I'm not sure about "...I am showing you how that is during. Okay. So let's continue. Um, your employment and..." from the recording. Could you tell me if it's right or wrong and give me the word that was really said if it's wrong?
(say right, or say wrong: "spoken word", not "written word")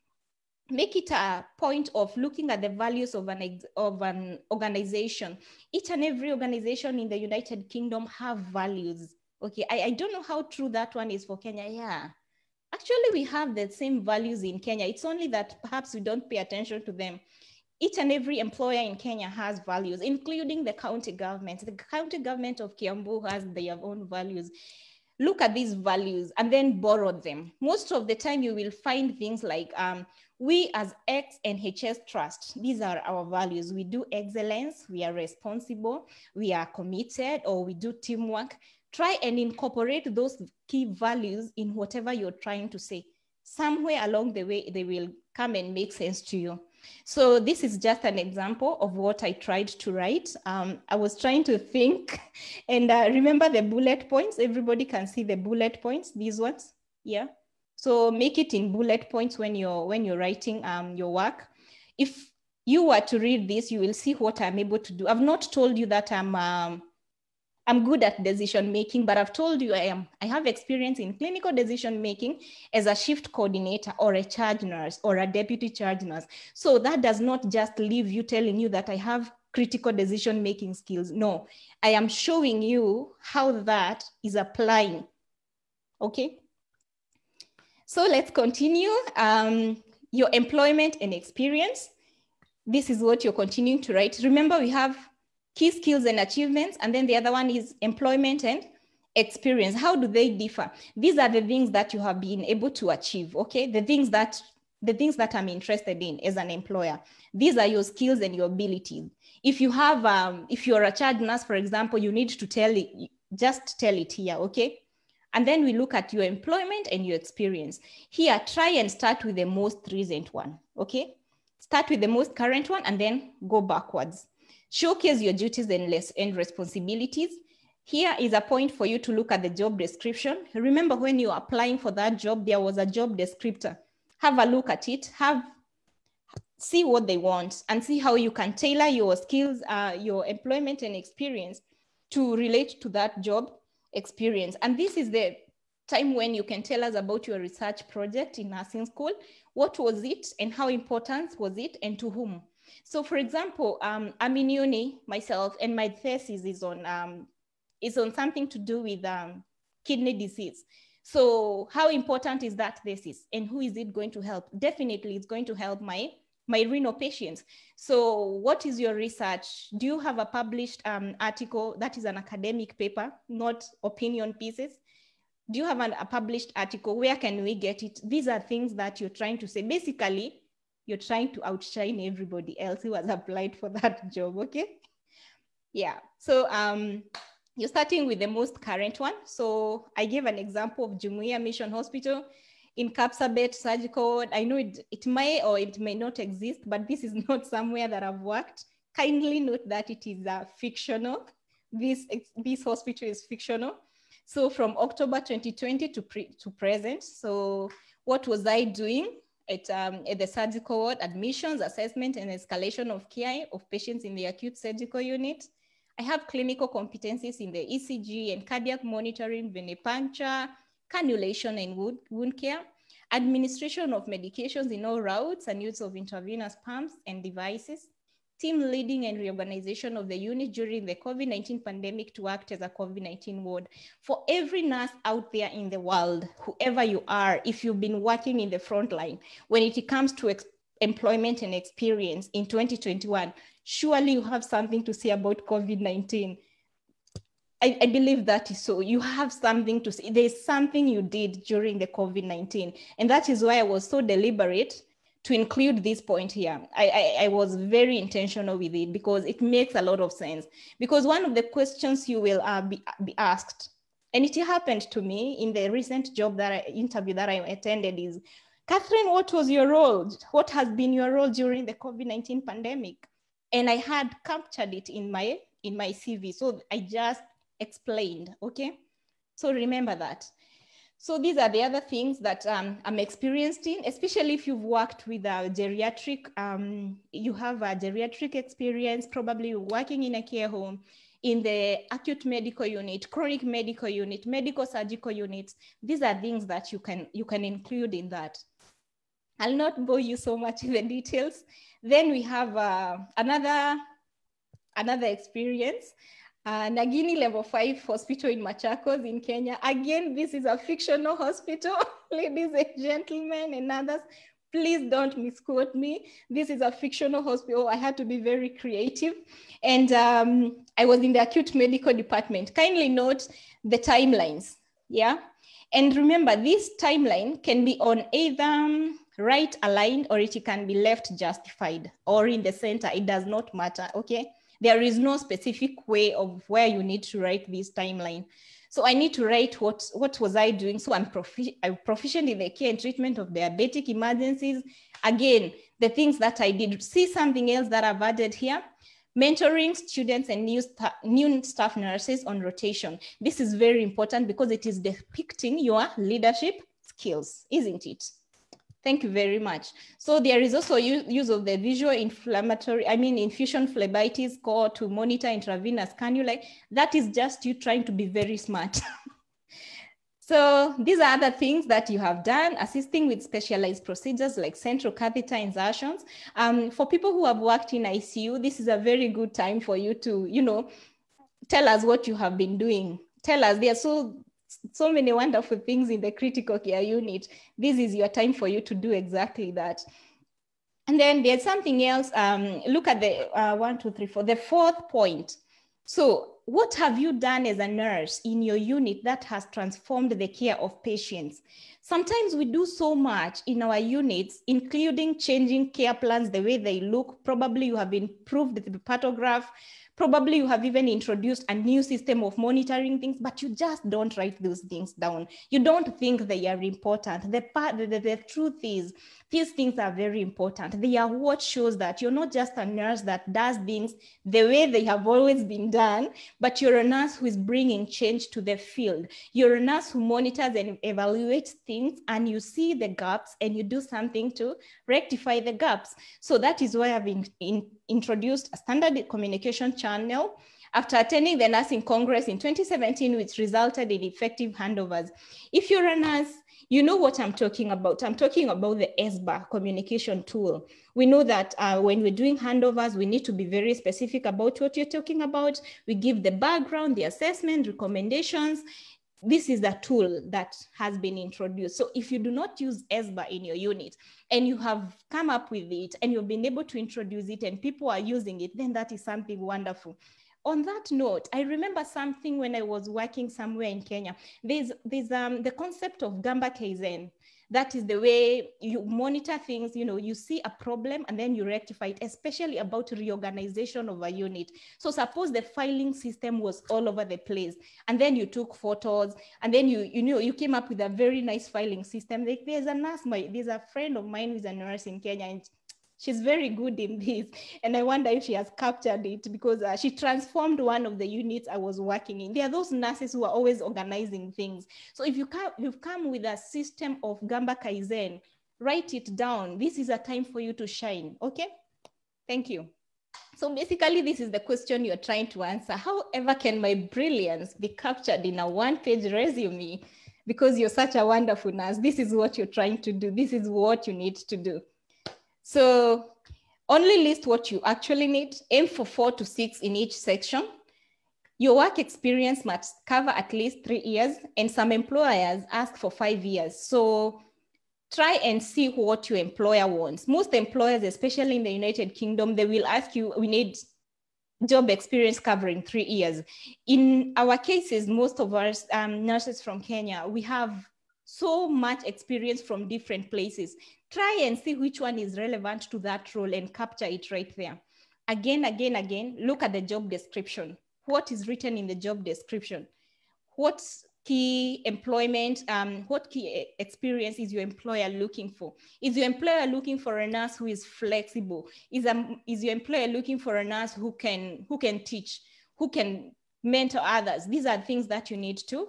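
wrong: "applying", not "during".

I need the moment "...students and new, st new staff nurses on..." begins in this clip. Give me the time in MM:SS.
05:49.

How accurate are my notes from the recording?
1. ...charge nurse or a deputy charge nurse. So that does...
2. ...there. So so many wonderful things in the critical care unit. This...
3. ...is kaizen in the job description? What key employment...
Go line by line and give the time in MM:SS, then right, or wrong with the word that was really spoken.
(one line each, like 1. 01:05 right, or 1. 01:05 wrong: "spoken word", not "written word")
1. 01:14 right
2. 06:23 right
3. 09:21 wrong: "written", not "kaizen".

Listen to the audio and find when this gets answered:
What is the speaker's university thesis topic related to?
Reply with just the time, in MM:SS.
02:39.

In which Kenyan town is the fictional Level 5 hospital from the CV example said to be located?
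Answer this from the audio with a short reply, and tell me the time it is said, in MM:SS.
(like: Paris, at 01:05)
Machakos, at 05:08.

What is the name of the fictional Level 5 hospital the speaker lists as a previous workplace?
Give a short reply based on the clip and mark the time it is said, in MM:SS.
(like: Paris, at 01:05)
Nagini Level 5 Hospital, at 05:06.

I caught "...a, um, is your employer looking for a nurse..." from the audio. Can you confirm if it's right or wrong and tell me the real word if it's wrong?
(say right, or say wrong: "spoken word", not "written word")
right.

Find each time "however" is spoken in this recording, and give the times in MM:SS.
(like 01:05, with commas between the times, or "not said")
08:35.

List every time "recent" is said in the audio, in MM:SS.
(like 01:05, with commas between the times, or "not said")
01:59, 04:25.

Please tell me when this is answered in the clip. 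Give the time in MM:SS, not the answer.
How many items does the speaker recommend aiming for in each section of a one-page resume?
08:48.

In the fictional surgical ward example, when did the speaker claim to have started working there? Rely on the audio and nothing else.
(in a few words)
October 2020.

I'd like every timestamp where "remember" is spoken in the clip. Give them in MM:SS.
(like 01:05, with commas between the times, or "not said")
00:53, 01:34, 02:10, 04:39, 05:25, 07:51.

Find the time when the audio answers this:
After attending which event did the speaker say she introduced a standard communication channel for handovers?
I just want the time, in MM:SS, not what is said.
07:21.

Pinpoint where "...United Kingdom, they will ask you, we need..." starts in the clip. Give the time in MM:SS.
09:01.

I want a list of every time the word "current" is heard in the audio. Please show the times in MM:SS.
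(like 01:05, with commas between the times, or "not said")
02:02, 03:08.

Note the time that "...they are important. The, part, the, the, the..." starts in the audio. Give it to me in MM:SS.
06:56.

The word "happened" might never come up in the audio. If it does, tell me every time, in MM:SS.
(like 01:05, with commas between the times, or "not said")
04:24.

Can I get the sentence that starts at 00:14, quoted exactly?
It's only that perhaps we don't pay attention to them.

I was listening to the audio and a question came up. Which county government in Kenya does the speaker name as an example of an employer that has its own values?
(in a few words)
Kiambu.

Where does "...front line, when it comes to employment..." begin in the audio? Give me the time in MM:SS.
03:58.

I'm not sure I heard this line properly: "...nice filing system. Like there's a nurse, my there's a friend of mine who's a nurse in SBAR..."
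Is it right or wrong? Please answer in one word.
wrong.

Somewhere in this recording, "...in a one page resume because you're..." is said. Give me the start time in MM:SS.
08:38.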